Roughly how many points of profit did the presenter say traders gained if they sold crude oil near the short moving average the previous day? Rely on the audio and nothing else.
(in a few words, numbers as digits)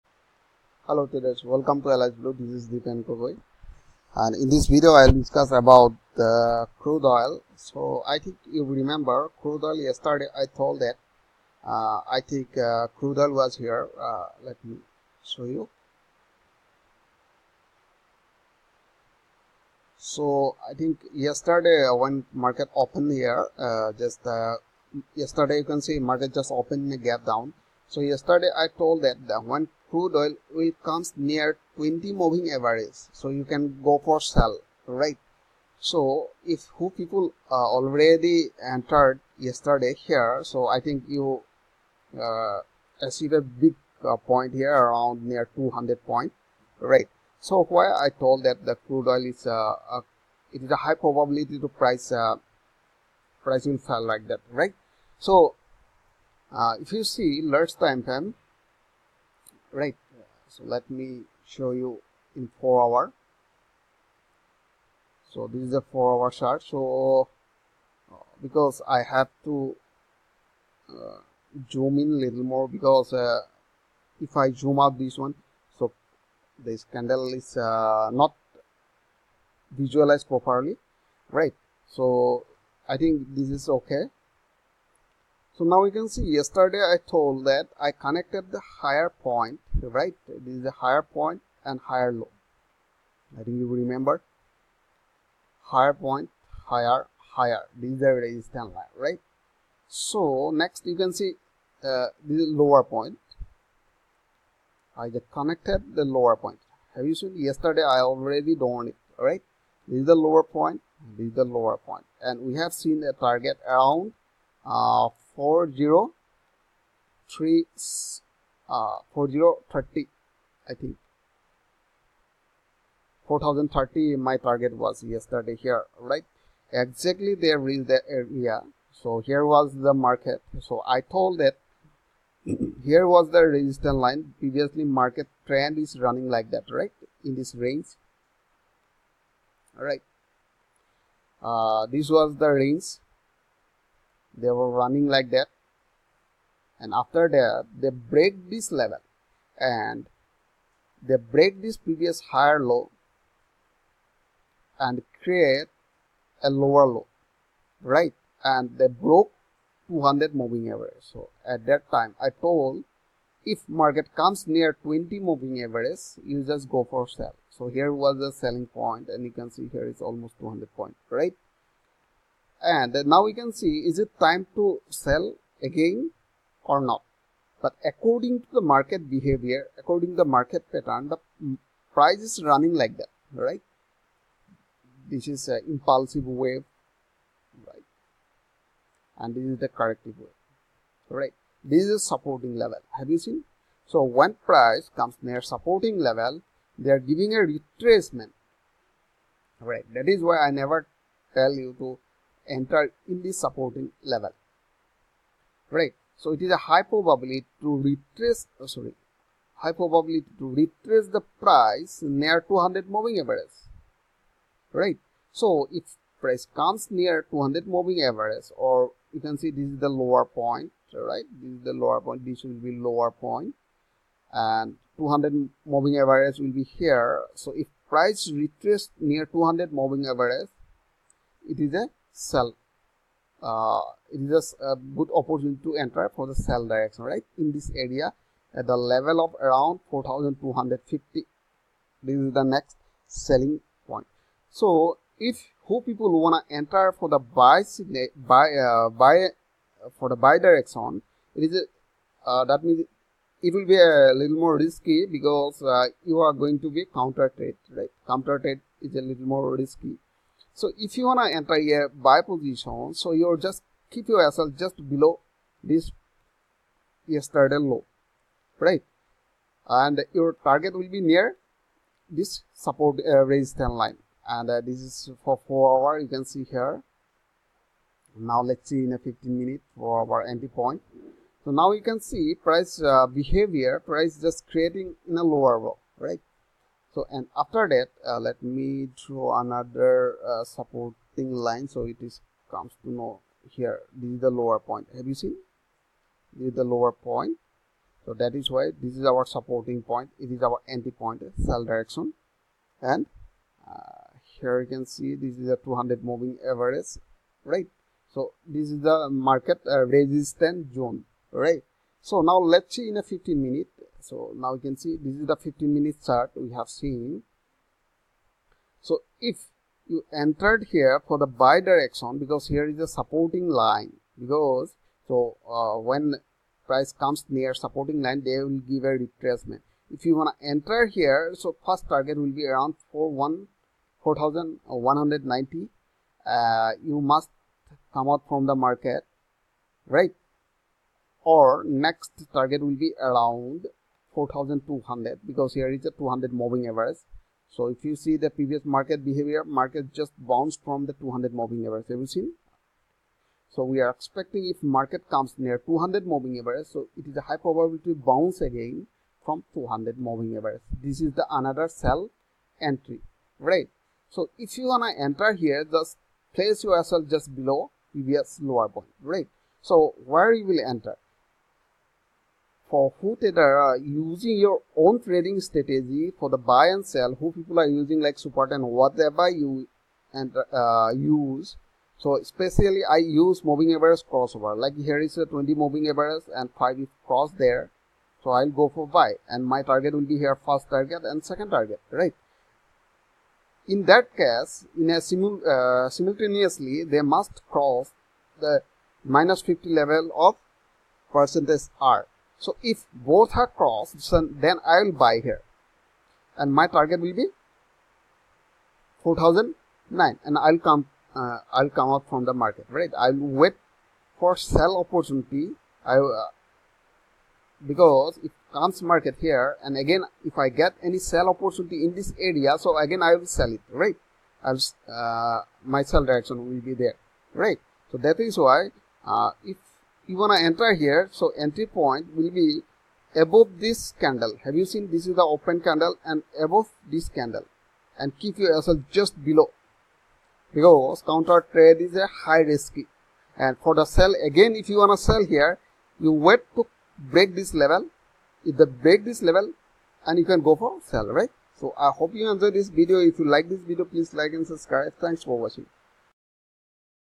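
200.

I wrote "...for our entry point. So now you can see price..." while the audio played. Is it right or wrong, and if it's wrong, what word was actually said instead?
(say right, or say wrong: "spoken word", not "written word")
right.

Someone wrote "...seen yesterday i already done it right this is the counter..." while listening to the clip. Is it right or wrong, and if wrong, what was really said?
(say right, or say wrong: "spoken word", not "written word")
wrong: "lower", not "counter".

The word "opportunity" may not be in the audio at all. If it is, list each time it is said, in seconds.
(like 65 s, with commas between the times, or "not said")
235 s, 414 s, 421 s.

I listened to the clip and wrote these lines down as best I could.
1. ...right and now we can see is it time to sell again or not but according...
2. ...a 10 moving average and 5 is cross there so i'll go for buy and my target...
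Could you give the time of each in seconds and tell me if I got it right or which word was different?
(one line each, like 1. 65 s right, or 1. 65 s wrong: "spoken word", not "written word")
1. 171 s right
2. 385 s wrong: "20", not "10".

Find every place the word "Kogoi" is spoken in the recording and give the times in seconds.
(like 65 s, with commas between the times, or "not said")
3 s.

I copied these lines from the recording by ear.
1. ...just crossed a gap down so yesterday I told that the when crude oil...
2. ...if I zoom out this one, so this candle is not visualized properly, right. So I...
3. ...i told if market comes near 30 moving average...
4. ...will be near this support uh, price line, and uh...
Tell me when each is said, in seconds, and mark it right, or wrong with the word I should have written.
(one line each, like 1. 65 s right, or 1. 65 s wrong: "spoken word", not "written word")
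1. 26 s wrong: "opened", not "crossed"
2. 74 s right
3. 162 s wrong: "20", not "30"
4. 270 s wrong: "resistance", not "price".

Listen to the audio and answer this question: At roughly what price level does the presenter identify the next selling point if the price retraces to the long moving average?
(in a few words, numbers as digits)
4250.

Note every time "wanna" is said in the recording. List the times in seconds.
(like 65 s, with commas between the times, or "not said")
246 s, 261 s, 364 s.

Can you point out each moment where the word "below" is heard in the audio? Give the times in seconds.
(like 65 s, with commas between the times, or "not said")
264 s, 367 s, 439 s.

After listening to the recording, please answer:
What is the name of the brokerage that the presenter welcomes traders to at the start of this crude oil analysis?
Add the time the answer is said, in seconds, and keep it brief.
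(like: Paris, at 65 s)
Alice Blue, at 1 s.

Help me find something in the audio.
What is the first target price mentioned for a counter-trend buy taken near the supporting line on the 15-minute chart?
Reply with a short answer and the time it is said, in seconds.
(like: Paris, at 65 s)
4190, at 334 s.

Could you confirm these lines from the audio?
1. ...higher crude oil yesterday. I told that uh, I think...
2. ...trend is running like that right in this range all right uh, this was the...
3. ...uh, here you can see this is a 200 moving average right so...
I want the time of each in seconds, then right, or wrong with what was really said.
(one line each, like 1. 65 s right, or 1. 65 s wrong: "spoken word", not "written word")
1. 8 s wrong: "remember", not "higher"
2. 135 s right
3. 303 s right.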